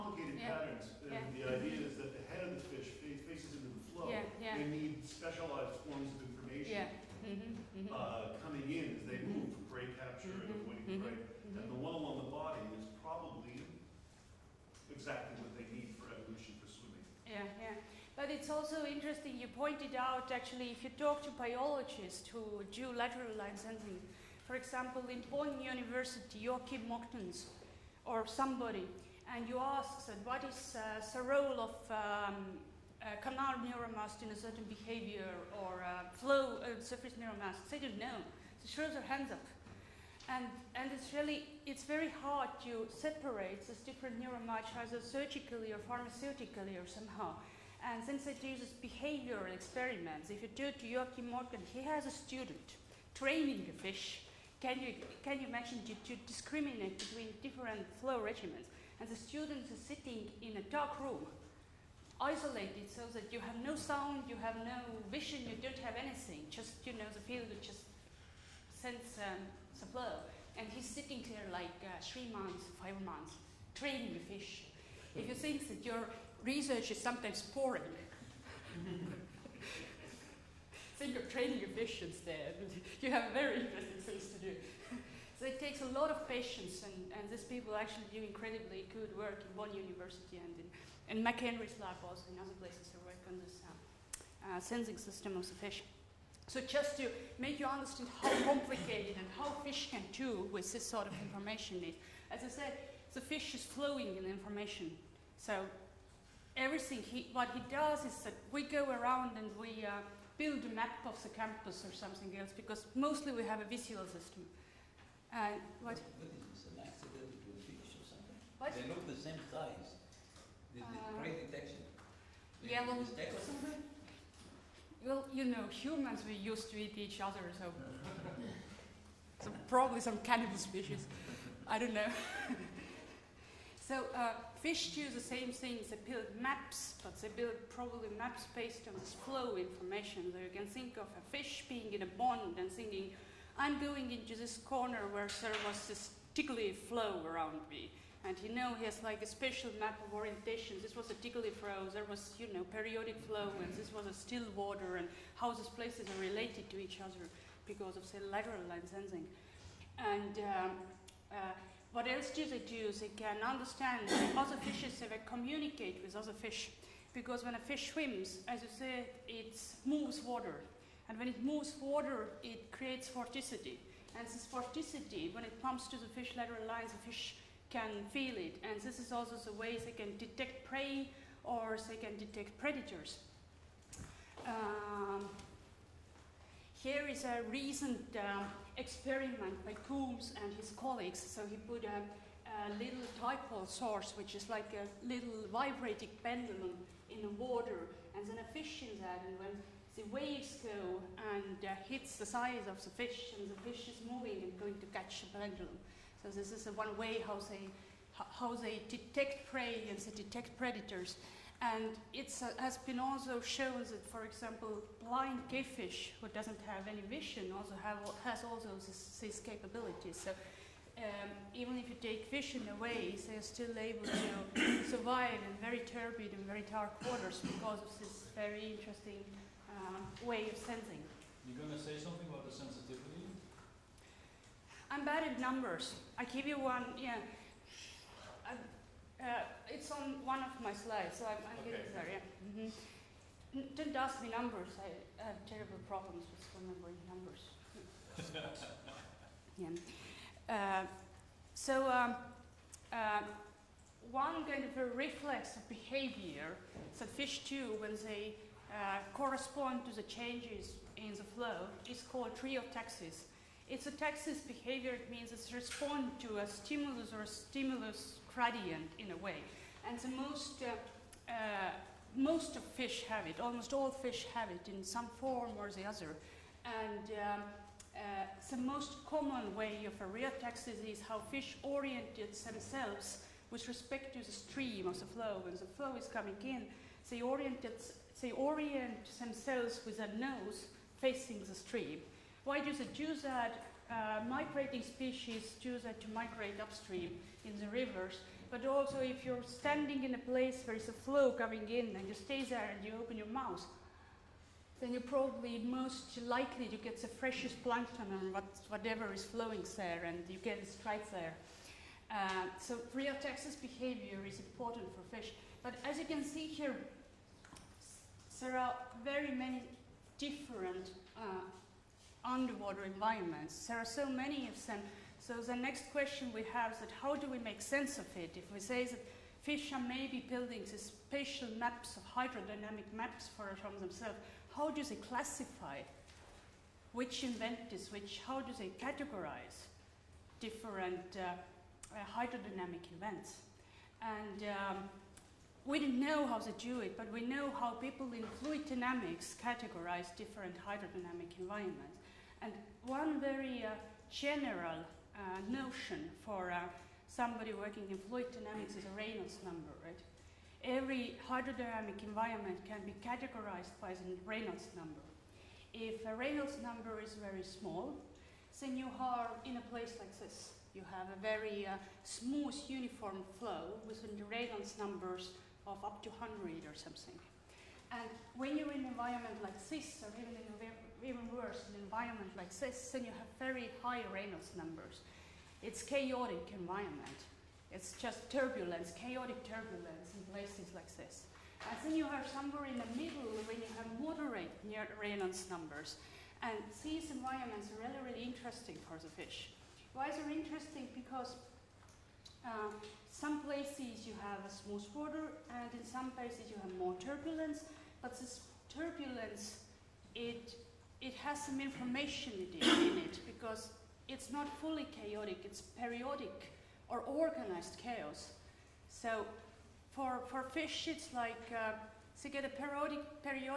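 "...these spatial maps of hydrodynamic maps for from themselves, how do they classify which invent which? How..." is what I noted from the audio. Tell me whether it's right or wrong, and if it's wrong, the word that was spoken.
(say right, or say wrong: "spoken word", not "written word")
right.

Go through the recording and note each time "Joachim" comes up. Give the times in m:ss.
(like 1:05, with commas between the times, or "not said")
0:26, 0:50.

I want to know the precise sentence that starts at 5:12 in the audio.
Uh, so rheotaxis behavior is important for fish.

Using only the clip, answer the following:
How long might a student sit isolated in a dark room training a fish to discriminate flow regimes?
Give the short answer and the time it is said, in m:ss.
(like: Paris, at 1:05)
three months, five months, at 1:12.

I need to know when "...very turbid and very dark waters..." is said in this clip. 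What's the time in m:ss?
3:45.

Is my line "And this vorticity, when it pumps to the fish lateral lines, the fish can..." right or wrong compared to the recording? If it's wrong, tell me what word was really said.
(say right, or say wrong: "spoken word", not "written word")
right.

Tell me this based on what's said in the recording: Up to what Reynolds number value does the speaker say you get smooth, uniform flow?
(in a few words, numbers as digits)
100.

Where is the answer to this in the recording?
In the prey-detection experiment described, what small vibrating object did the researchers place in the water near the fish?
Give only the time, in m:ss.
3:13.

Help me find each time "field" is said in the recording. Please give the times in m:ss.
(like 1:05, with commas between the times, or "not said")
1:07.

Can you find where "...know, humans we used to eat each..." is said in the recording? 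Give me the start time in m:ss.
2:05.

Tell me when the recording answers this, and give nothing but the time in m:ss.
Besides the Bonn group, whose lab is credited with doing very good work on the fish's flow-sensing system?
1:31.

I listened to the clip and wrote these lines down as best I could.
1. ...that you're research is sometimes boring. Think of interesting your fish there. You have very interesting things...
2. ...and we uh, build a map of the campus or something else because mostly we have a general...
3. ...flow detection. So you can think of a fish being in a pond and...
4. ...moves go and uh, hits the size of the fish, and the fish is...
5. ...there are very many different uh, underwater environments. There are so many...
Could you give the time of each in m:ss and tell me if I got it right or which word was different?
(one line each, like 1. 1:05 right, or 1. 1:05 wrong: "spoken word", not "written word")
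1. 1:15 wrong: "training", not "interesting"
2. 1:49 wrong: "visual", not "general"
3. 2:19 wrong: "information", not "detection"
4. 3:20 wrong: "waves", not "moves"
5. 5:18 right.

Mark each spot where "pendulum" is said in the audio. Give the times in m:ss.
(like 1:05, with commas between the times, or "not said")
3:16, 3:25.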